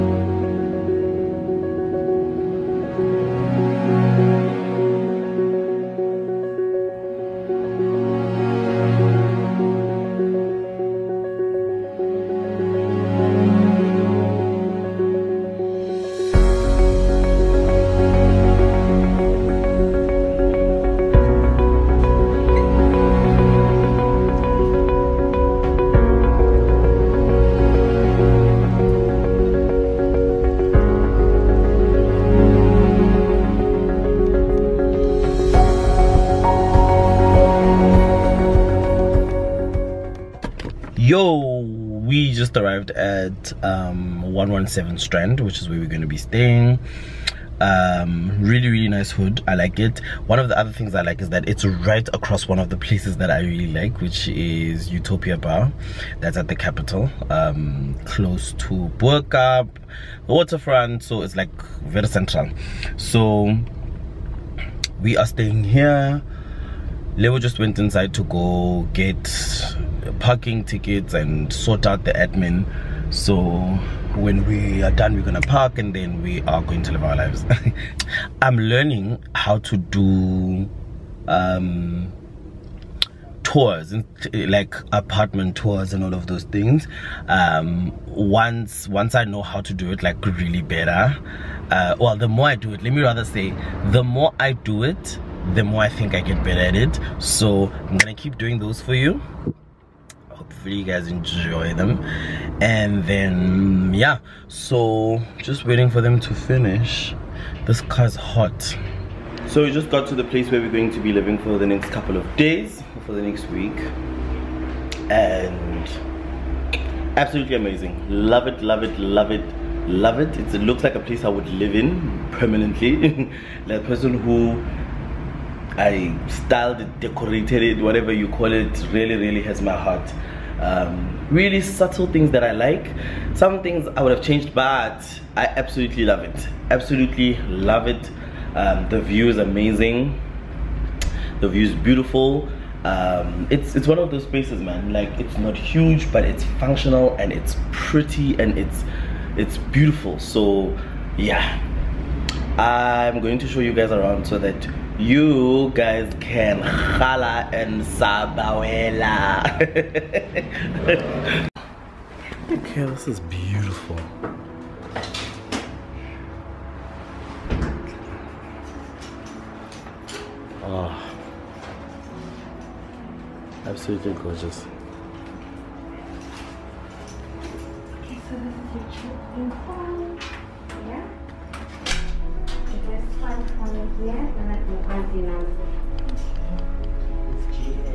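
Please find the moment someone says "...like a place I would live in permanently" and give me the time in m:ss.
2:00.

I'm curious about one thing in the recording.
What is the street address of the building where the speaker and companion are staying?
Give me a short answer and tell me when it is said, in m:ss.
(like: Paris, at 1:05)
117 Strand, at 0:44.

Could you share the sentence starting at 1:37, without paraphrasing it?
So I'm gonna keep doing those for you.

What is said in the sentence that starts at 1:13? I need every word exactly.
So when we are done, we're gonna park and then we are going to live our lives.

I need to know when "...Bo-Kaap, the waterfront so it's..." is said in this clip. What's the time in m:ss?
0:58.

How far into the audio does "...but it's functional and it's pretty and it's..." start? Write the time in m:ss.
2:26.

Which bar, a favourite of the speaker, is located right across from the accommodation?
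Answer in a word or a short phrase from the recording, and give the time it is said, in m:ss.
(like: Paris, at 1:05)
Utopia, at 0:54.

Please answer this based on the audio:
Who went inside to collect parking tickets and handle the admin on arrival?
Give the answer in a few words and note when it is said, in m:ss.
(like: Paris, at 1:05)
Leo, at 1:07.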